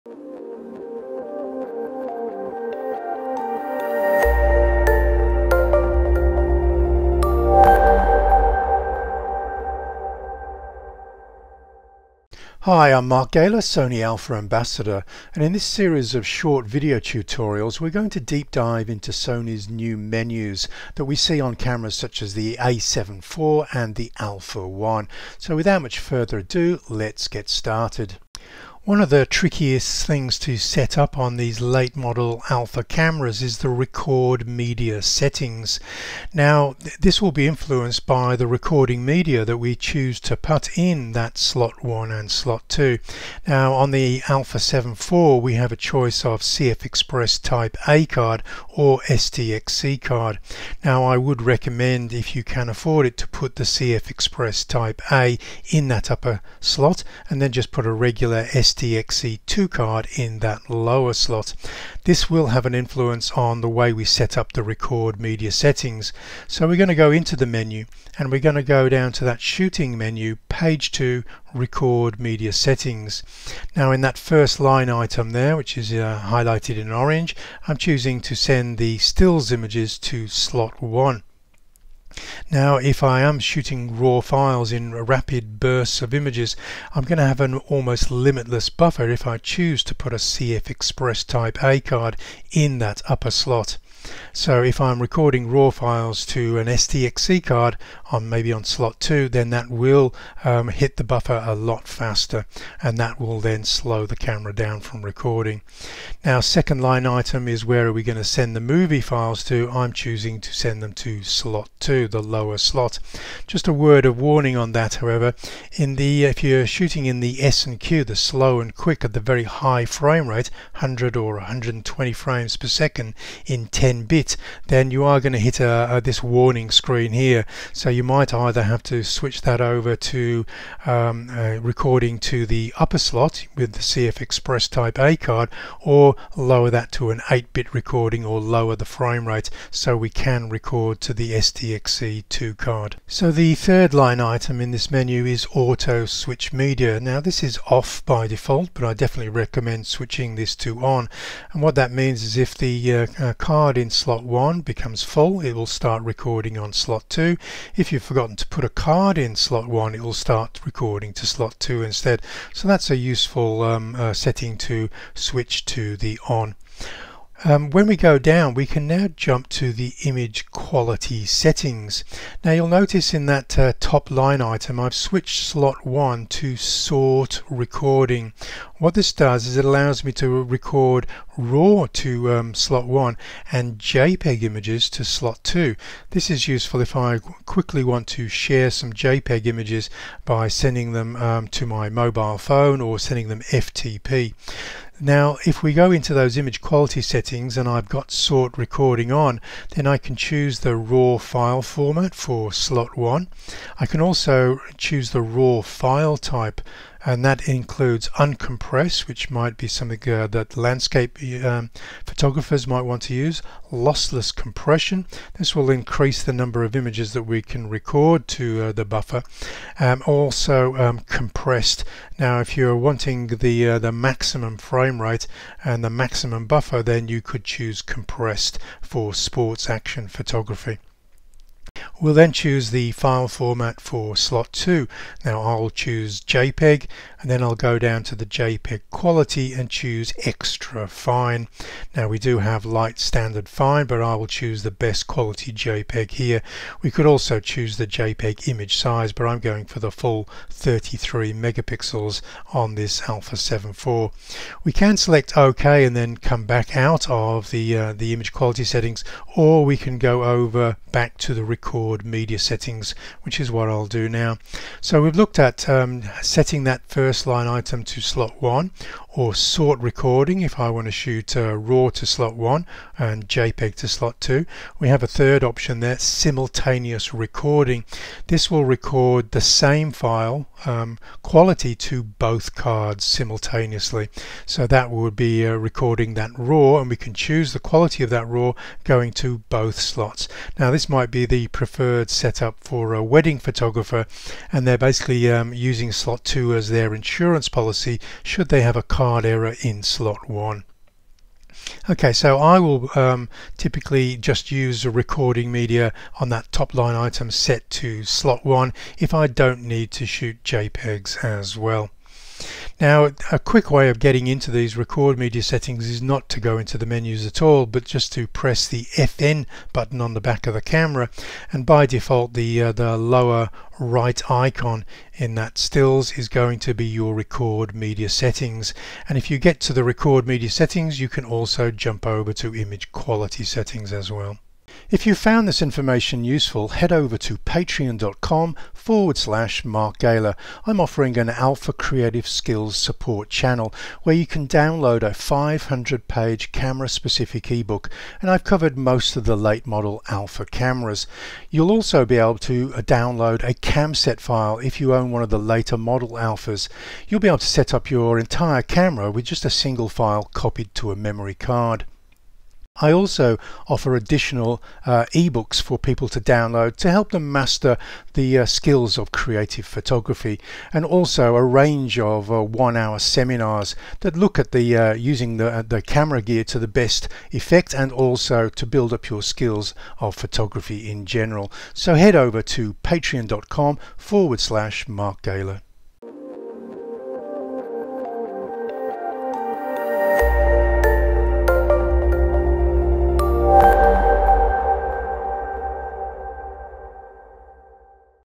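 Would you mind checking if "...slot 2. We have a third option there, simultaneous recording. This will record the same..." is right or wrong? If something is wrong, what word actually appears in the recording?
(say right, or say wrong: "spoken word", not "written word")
right.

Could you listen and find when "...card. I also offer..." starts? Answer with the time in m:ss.
6:01.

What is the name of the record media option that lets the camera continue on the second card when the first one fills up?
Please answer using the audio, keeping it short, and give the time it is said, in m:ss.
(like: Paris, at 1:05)
Auto Switch Media, at 2:25.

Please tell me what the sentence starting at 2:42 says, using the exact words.
So that's a useful um, uh, setting to switch to the on.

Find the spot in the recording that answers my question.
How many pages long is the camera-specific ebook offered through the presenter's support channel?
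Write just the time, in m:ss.
5:45.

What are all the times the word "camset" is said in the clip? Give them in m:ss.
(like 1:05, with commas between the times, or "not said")
5:53.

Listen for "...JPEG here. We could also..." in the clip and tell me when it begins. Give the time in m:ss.
4:05.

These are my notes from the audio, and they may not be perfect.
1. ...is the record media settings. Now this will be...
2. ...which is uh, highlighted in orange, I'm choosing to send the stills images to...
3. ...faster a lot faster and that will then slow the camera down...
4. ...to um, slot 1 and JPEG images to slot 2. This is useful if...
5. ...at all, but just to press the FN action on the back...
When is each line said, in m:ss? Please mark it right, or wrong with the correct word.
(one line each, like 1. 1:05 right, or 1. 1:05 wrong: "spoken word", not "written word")
1. 0:33 right
2. 1:15 right
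3. 1:41 wrong: "buffer", not "faster"
4. 3:01 right
5. 5:17 wrong: "button", not "action".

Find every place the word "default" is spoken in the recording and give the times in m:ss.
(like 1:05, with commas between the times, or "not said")
2:28, 5:21.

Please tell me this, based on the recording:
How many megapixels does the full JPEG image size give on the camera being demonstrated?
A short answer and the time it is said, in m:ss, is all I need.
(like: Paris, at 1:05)
33, at 4:10.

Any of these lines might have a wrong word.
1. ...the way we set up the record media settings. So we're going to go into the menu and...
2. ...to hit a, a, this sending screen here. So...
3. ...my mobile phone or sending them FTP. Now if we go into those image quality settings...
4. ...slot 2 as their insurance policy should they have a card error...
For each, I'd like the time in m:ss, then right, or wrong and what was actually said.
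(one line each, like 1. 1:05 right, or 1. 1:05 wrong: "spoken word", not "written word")
1. 1:03 right
2. 2:05 wrong: "warning", not "sending"
3. 3:11 right
4. 4:55 right.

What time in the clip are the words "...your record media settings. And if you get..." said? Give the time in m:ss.
5:26.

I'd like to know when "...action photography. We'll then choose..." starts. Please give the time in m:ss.
3:49.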